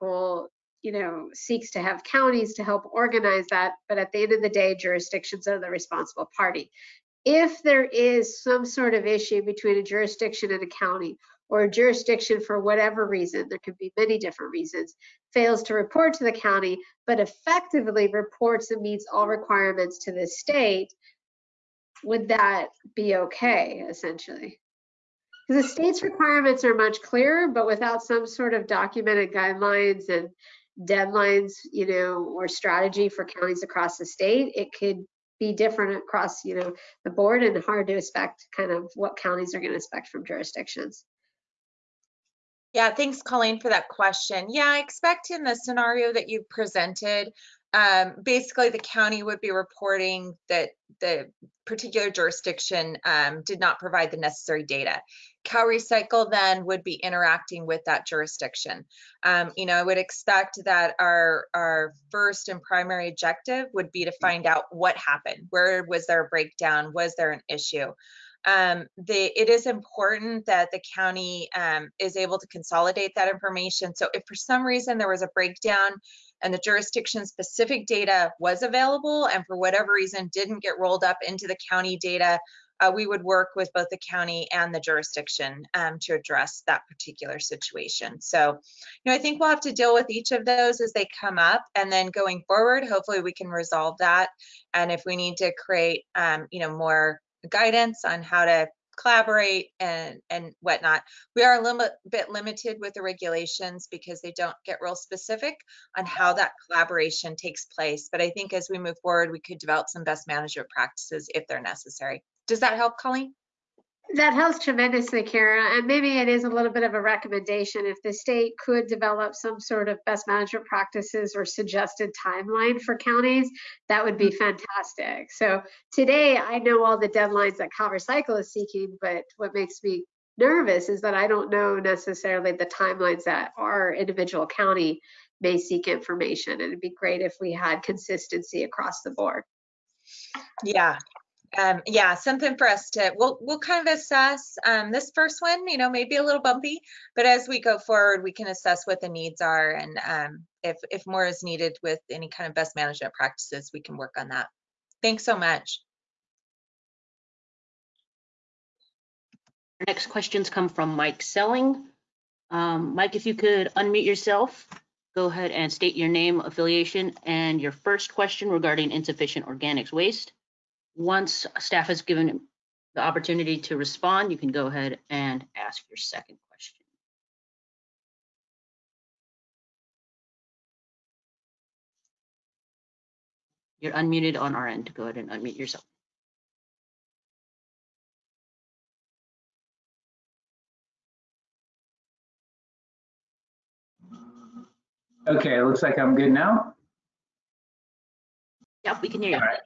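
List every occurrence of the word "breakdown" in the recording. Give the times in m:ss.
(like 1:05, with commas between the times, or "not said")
1:06, 1:15.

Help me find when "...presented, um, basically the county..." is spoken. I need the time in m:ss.
0:46.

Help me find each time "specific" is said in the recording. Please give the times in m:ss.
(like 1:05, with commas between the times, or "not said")
1:17, 1:44.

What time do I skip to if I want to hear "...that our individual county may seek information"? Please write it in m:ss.
2:13.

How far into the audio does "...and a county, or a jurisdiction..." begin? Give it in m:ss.
0:10.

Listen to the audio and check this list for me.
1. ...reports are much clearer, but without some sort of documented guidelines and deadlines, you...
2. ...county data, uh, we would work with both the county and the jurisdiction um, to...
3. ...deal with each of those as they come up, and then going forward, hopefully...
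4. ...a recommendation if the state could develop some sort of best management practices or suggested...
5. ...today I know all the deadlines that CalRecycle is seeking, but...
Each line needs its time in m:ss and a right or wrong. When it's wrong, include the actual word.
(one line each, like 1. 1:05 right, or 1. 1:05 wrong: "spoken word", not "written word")
1. 0:26 wrong: "requirements", not "reports"
2. 1:21 right
3. 1:29 right
4. 1:56 right
5. 2:05 right.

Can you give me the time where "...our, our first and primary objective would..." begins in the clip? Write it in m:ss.
1:00.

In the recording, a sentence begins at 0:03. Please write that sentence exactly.
But at the end of the day, jurisdictions are the responsible party.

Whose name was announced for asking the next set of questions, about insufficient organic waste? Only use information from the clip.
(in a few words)
Mike Selling.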